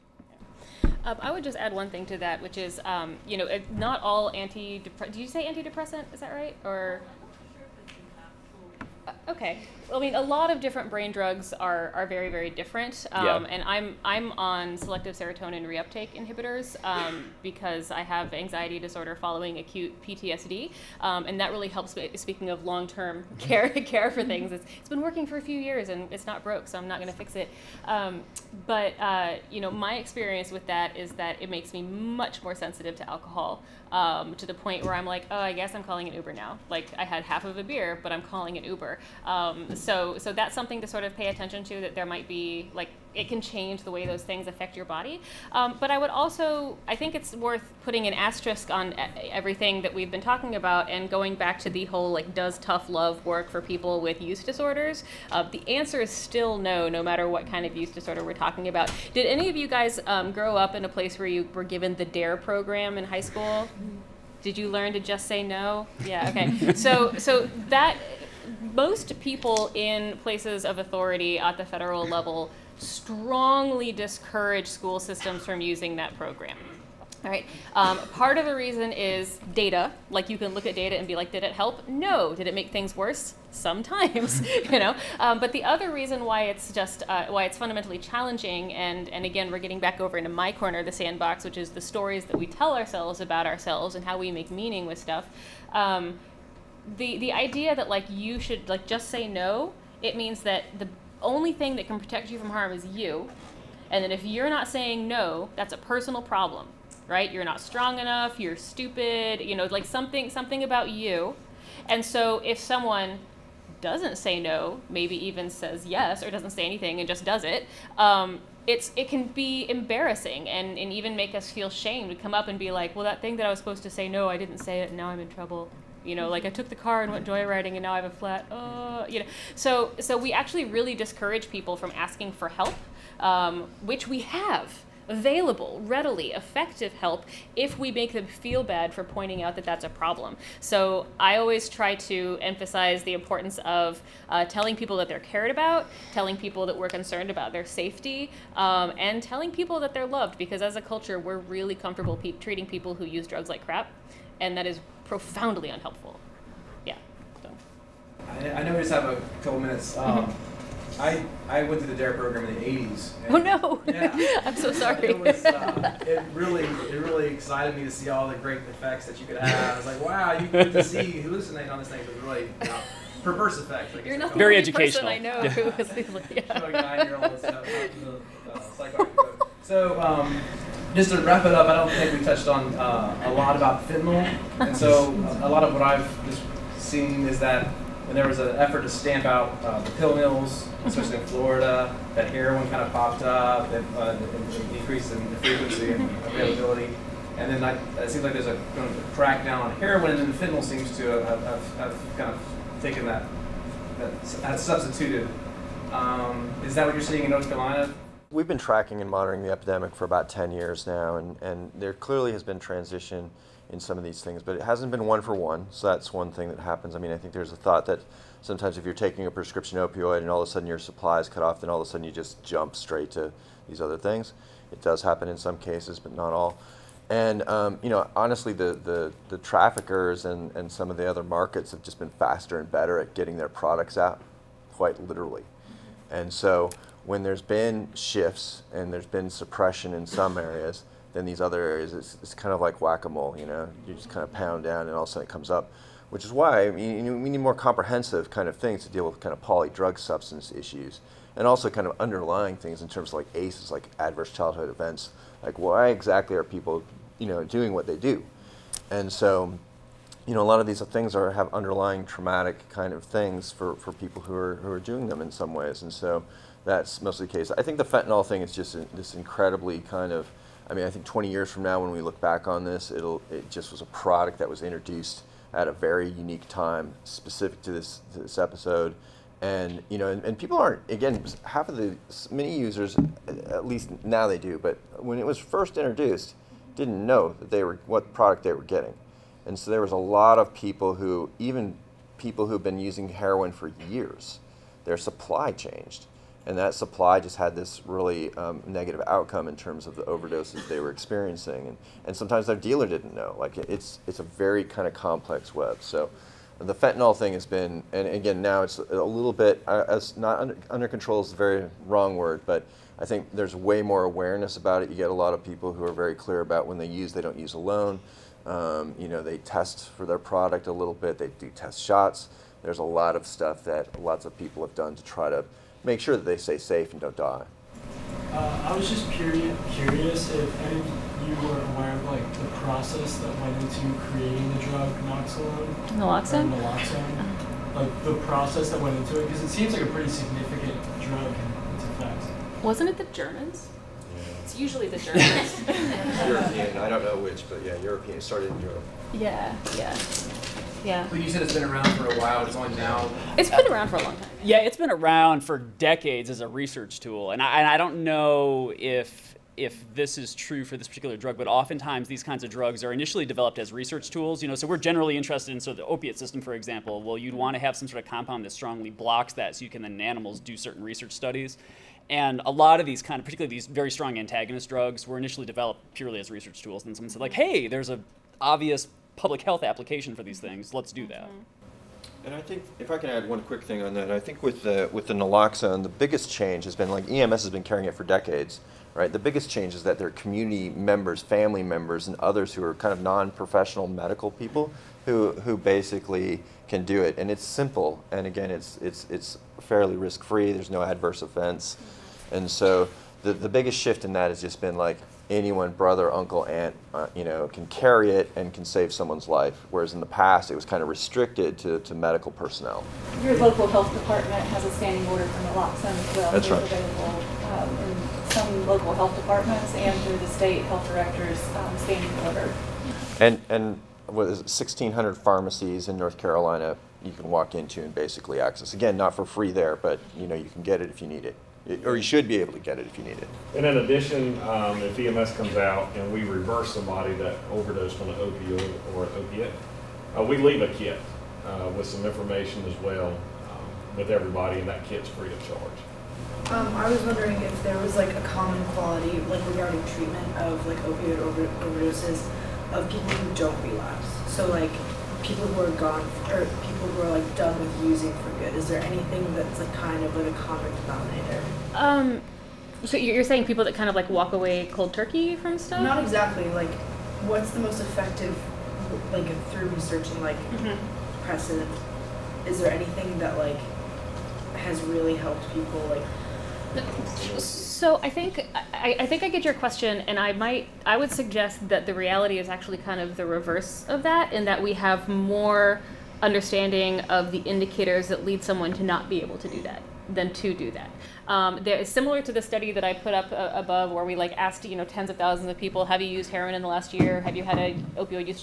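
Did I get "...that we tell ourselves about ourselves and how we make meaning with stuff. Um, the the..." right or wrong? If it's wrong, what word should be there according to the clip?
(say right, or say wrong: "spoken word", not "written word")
right.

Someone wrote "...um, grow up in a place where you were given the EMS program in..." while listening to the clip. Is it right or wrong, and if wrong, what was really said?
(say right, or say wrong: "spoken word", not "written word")
wrong: "DARE", not "EMS".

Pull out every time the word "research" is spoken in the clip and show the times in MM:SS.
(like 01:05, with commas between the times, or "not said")
05:56, 06:03, 06:10, 06:16, 07:49.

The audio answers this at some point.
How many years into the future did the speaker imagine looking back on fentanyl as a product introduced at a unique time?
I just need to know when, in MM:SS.
04:31.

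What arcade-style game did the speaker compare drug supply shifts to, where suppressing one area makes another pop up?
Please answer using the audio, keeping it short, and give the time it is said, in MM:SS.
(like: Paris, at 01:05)
whack-a-mole, at 04:02.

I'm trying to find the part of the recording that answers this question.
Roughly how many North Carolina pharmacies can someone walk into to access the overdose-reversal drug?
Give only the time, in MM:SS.
07:04.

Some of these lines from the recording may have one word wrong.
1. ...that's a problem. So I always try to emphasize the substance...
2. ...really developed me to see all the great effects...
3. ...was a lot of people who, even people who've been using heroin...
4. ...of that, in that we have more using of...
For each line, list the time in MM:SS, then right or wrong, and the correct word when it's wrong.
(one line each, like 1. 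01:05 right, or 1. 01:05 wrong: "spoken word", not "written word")
1. 02:19 wrong: "importance", not "substance"
2. 02:47 wrong: "excited", not "developed"
3. 04:49 right
4. 08:03 wrong: "understanding", not "using".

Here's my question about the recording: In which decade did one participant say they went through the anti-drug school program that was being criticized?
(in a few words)
the 1980s.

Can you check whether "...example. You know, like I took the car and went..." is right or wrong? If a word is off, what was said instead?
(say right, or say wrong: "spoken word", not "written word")
wrong: "trouble", not "example".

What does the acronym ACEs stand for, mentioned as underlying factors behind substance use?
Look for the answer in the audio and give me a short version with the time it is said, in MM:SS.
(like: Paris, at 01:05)
adverse childhood events, at 04:13.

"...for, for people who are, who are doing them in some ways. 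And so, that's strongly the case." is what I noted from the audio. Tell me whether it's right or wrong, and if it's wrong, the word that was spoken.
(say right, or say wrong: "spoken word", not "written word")
wrong: "mostly", not "strongly".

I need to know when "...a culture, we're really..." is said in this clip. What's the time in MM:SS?
02:30.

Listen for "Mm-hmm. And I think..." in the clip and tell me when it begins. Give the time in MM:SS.
06:21.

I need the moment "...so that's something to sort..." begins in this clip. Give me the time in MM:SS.
00:40.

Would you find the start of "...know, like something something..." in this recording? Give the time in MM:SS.
01:49.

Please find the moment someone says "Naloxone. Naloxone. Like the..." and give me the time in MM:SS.
05:35.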